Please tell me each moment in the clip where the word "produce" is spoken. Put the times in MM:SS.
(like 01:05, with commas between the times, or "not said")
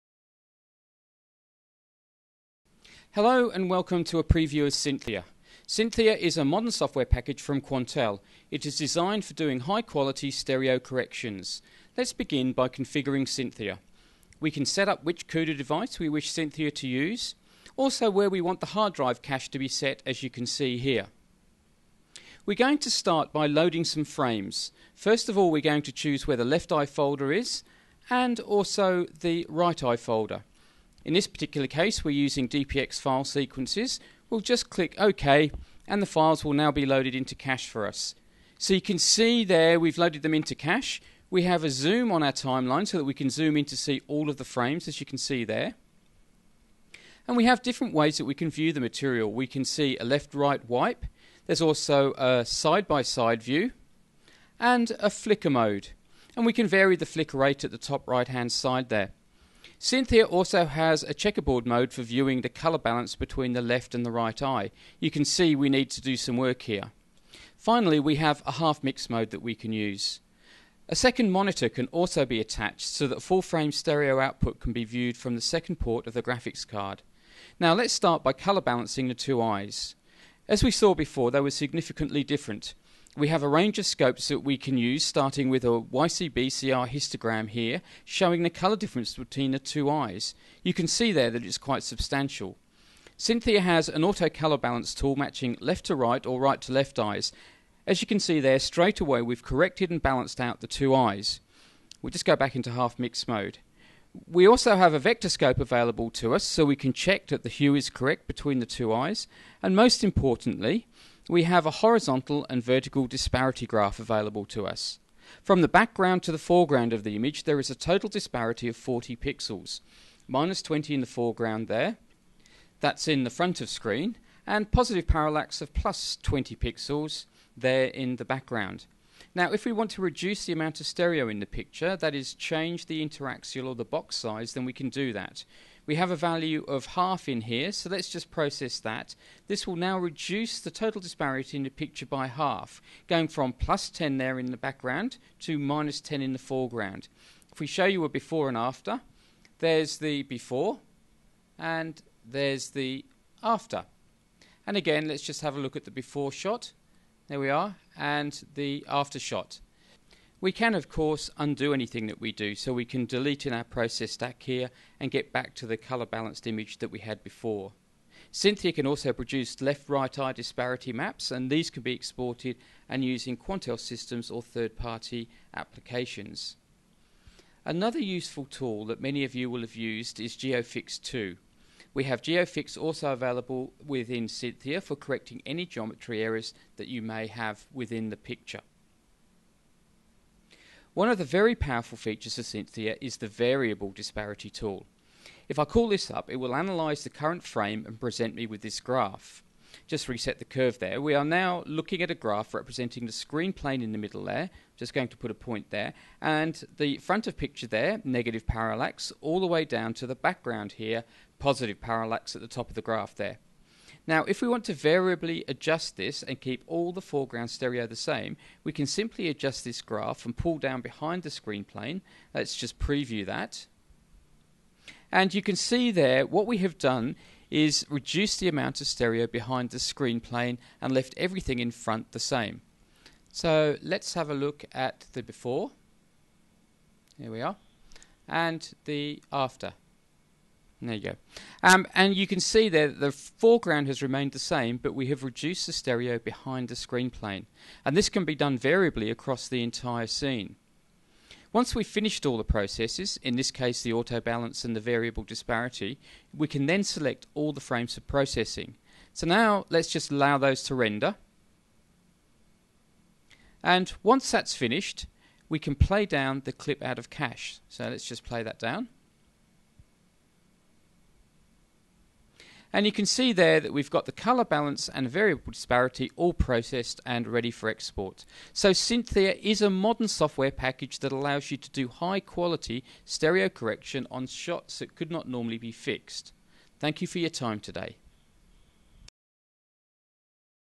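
02:49.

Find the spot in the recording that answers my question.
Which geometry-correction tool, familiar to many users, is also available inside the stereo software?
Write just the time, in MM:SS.
03:00.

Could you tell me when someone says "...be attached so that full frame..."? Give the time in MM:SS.
01:12.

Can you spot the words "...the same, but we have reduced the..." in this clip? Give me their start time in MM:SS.
04:04.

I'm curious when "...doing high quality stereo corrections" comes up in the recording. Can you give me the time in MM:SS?
00:09.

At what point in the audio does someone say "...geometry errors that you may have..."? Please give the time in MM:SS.
03:05.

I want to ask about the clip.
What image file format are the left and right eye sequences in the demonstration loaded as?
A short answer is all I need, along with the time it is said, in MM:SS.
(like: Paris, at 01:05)
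DPX, at 00:32.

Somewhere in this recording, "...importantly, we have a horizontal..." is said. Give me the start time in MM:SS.
01:50.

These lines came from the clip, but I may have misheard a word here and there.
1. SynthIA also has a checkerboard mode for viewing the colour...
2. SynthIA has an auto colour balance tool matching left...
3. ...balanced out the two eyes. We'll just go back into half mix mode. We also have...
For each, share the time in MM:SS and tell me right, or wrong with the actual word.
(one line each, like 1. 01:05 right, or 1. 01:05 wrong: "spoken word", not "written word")
1. 00:59 right
2. 01:33 right
3. 01:40 right.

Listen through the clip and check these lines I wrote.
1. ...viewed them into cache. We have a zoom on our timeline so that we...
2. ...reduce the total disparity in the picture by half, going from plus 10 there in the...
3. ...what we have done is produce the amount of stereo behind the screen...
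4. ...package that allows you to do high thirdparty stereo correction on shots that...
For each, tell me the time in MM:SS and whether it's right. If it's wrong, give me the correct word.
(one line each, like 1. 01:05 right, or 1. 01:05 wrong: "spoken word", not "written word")
1. 00:39 wrong: "loaded", not "viewed"
2. 02:19 right
3. 03:46 wrong: "reduce", not "produce"
4. 04:40 wrong: "quality", not "thirdparty".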